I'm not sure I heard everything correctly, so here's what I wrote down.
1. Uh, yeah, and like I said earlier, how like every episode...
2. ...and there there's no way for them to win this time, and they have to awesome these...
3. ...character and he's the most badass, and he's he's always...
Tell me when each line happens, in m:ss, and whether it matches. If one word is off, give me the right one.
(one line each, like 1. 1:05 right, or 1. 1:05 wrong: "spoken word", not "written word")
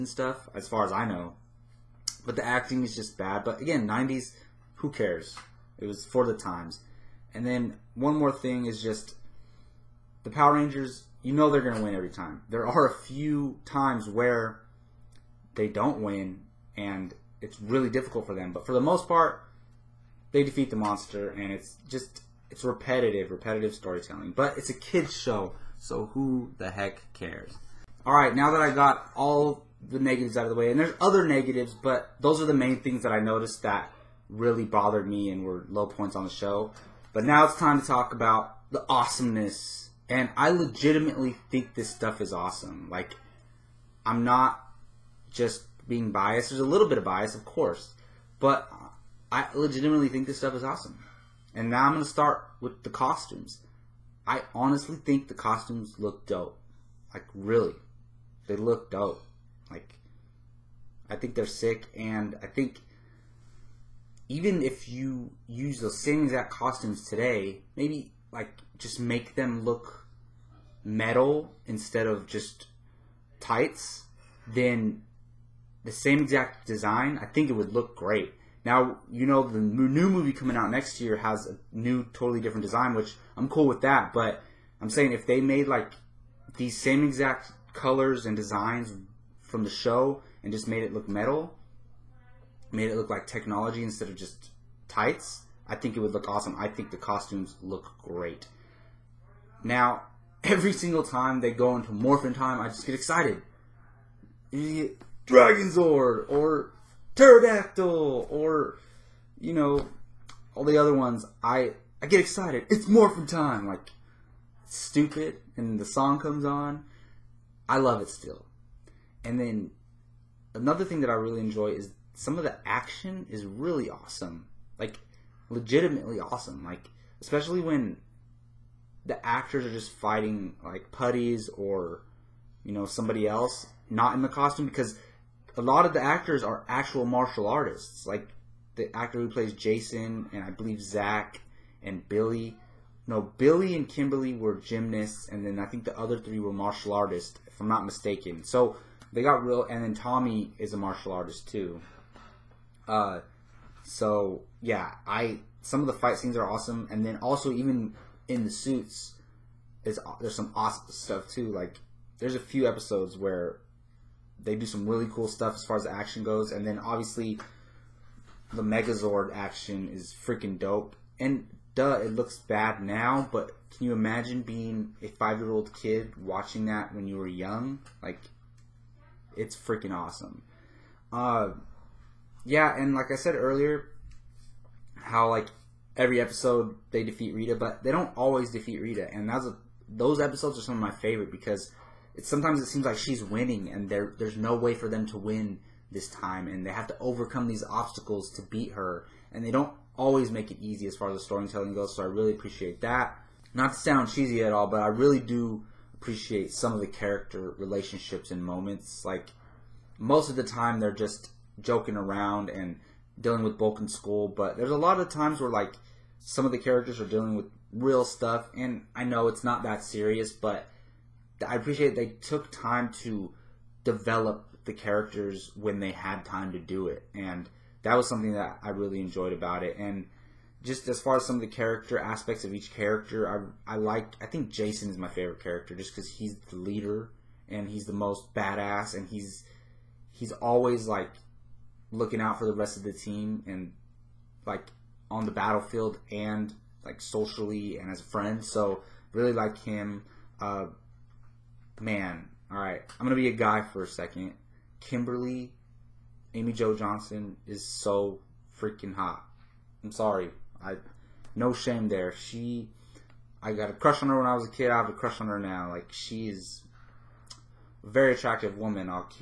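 1. 3:01 right
2. 3:13 wrong: "overcome", not "awesome"
3. 3:56 wrong: "leader", not "character".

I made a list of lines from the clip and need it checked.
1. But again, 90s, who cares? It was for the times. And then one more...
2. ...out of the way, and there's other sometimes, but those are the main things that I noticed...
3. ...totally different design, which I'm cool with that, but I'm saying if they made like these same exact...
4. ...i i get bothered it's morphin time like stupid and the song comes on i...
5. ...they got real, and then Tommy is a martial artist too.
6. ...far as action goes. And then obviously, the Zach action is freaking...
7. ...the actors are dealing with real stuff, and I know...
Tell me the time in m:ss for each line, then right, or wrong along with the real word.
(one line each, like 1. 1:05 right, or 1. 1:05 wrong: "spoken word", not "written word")
1. 0:03 right
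2. 0:30 wrong: "negatives", not "sometimes"
3. 1:22 right
4. 1:51 wrong: "excited", not "bothered"
5. 2:29 right
6. 2:45 wrong: "Megazord", not "Zach"
7. 3:36 wrong: "characters", not "actors".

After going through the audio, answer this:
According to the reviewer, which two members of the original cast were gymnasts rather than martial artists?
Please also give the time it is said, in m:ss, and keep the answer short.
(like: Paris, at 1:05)
Billy and Kimberly, at 2:23.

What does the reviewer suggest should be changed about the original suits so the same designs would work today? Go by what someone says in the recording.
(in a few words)
Make them look metal.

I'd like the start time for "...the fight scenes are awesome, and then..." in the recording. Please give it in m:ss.
2:35.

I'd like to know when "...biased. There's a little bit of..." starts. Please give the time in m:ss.
0:46.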